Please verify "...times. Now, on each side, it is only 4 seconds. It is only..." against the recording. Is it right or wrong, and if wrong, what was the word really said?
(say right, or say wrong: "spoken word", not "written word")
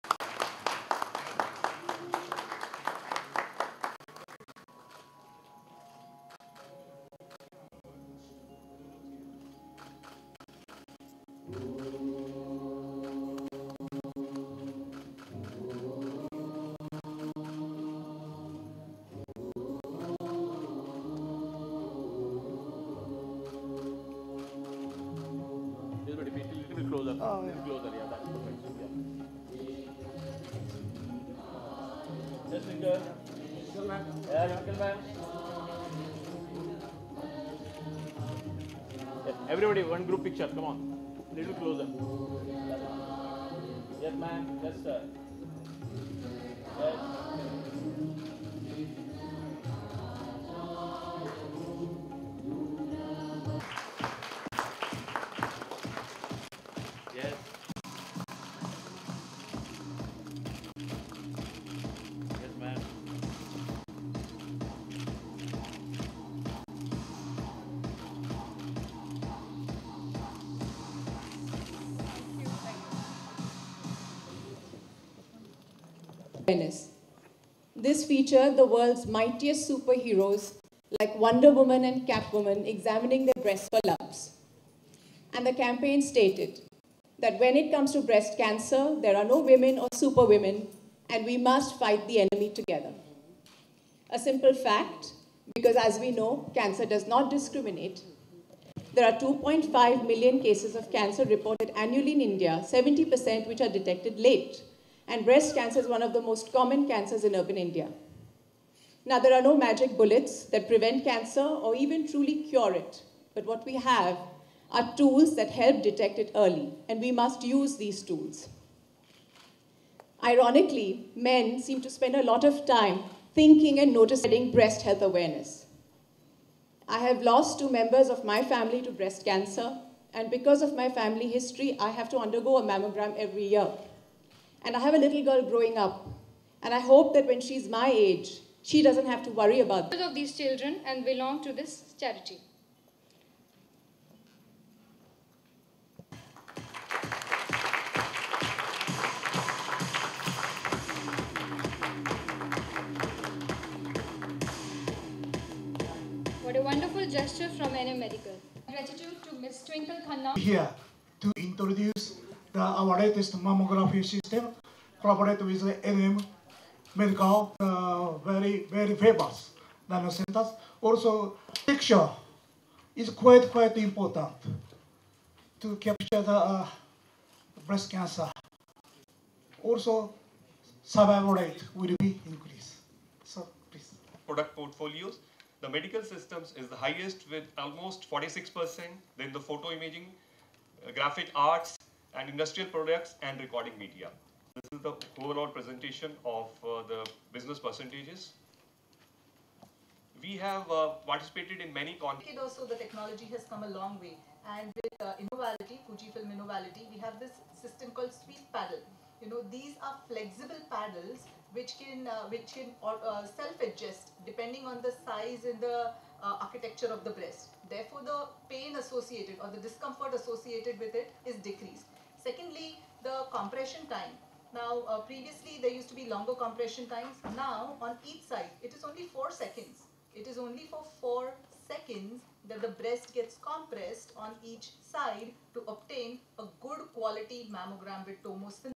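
right.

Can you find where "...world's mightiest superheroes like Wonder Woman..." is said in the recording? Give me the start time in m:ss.
1:18.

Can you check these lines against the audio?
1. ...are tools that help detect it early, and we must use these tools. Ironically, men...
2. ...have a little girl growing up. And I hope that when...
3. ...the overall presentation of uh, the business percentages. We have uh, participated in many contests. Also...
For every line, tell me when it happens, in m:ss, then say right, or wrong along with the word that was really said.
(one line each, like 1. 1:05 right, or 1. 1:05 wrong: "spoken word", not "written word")
1. 1:54 right
2. 2:14 right
3. 3:14 right.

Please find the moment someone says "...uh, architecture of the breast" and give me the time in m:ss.
3:36.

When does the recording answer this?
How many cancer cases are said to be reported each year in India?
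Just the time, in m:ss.
1:39.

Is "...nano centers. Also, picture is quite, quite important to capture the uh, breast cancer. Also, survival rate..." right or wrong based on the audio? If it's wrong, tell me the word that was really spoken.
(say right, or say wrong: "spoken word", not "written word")
right.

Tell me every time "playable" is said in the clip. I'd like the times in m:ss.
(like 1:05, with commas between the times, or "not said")
not said.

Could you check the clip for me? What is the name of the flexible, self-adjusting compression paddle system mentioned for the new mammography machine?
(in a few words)
Sweep Paddle.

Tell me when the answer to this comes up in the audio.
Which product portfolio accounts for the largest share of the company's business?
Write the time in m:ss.
3:05.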